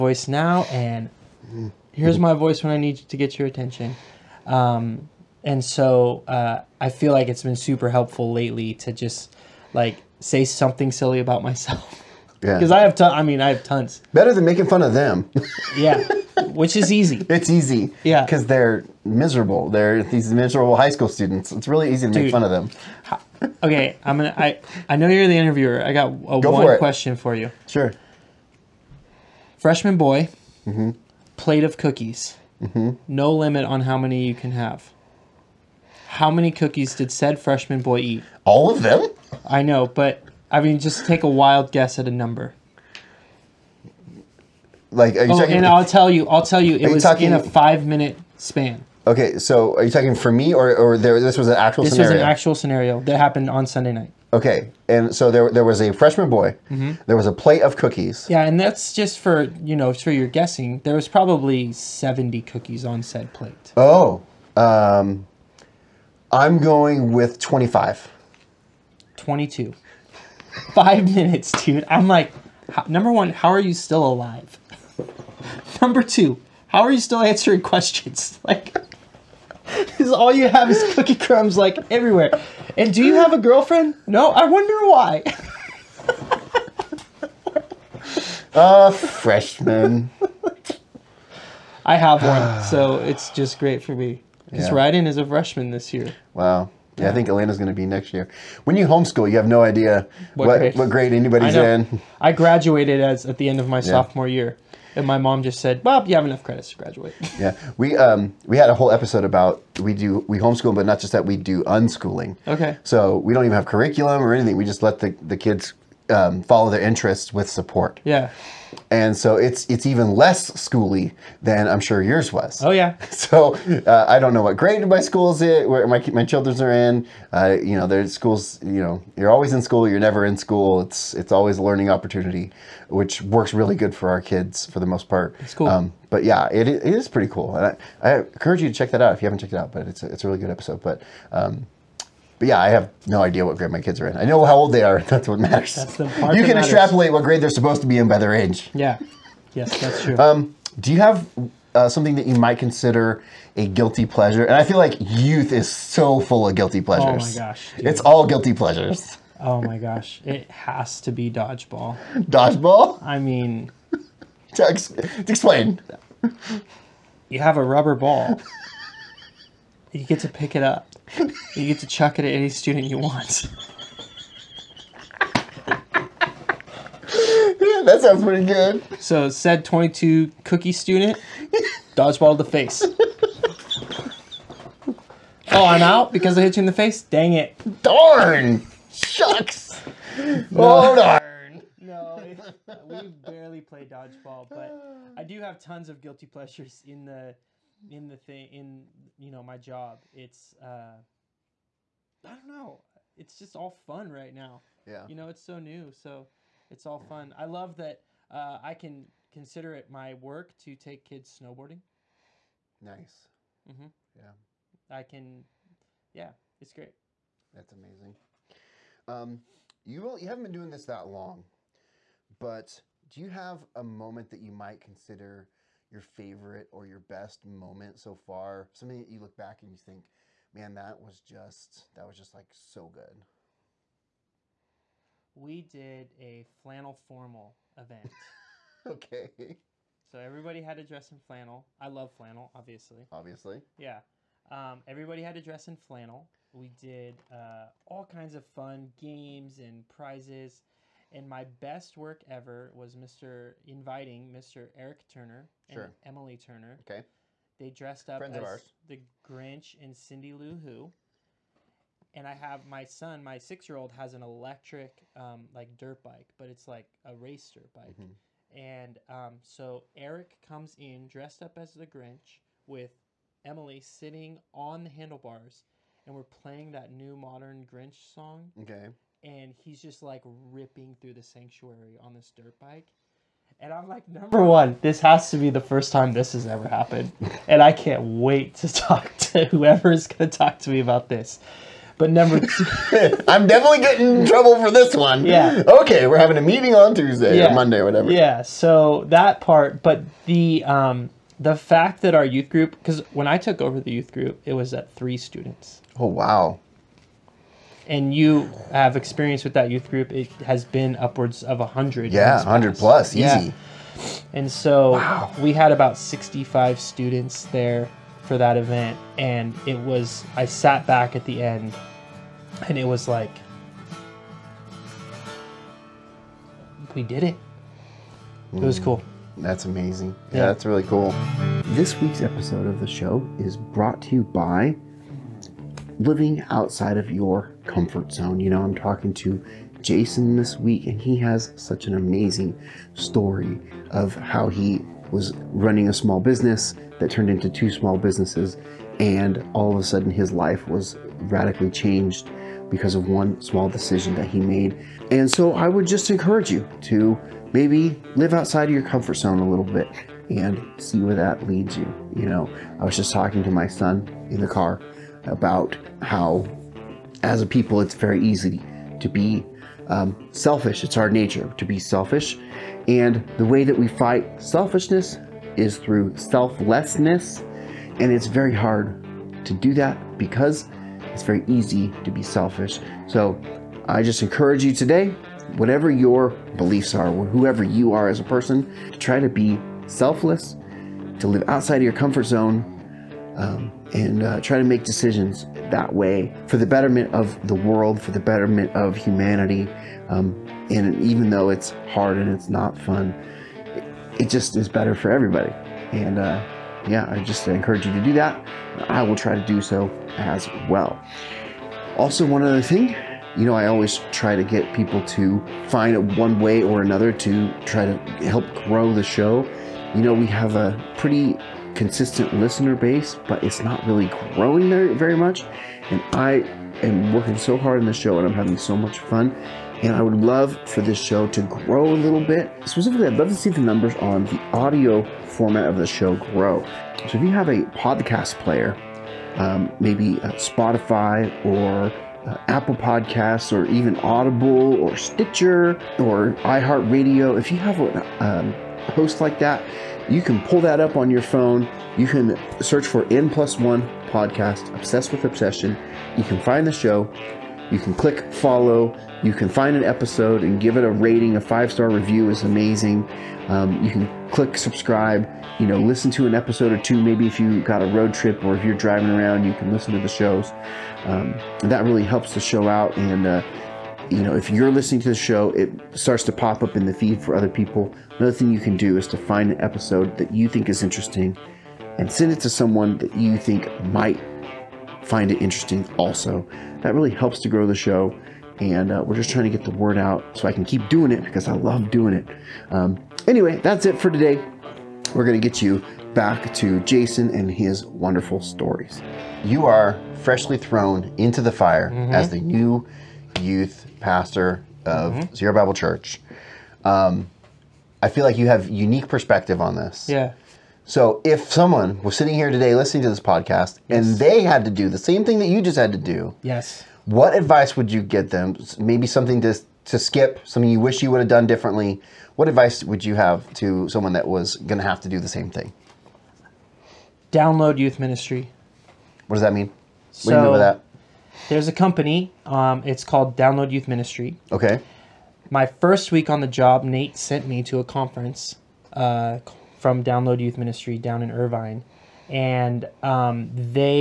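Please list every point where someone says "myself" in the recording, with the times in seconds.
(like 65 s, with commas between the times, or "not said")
11 s.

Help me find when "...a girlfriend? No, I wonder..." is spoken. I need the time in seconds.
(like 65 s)
83 s.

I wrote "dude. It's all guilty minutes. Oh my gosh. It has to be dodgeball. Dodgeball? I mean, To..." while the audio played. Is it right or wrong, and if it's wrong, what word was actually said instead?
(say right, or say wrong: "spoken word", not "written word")
wrong: "pleasures", not "minutes".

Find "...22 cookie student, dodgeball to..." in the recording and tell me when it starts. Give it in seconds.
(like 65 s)
179 s.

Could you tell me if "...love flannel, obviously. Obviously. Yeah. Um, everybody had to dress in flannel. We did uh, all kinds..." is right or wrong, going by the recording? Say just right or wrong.
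right.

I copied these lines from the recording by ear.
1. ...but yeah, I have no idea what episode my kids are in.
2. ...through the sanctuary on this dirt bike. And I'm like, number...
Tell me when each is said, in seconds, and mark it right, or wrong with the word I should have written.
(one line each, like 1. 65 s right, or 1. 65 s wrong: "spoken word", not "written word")
1. 142 s wrong: "grade", not "episode"
2. 280 s right.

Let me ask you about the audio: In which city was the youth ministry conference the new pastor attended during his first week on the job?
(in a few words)
Irvine.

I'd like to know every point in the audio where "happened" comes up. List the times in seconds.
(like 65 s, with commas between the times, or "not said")
53 s, 286 s.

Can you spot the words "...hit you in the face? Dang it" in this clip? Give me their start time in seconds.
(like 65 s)
186 s.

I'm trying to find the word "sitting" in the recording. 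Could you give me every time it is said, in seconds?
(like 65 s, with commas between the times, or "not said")
273 s, 512 s.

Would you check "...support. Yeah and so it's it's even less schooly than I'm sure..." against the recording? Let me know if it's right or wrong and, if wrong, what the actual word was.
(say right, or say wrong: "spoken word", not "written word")
right.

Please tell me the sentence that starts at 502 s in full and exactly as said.
as the new youth pastor of mm-hmm.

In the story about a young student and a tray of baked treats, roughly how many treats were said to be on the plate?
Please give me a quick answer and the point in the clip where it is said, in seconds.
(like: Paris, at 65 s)
70, at 61 s.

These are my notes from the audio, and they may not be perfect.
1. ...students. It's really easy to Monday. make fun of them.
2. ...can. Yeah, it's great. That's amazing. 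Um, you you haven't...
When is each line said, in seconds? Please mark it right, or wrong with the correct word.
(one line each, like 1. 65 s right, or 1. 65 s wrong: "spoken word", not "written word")
1. 21 s wrong: "Dude", not "Monday"
2. 215 s right.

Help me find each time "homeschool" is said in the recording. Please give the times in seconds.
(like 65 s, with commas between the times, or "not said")
98 s, 110 s.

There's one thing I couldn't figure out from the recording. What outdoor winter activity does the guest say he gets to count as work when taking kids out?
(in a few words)
Snowboarding.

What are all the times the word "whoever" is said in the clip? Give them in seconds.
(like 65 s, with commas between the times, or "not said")
289 s, 387 s.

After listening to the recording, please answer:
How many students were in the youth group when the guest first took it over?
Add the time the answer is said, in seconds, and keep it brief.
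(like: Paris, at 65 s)
3, at 304 s.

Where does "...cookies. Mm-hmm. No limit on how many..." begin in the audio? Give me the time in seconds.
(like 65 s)
31 s.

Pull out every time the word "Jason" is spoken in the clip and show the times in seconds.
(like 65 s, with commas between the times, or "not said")
339 s, 496 s.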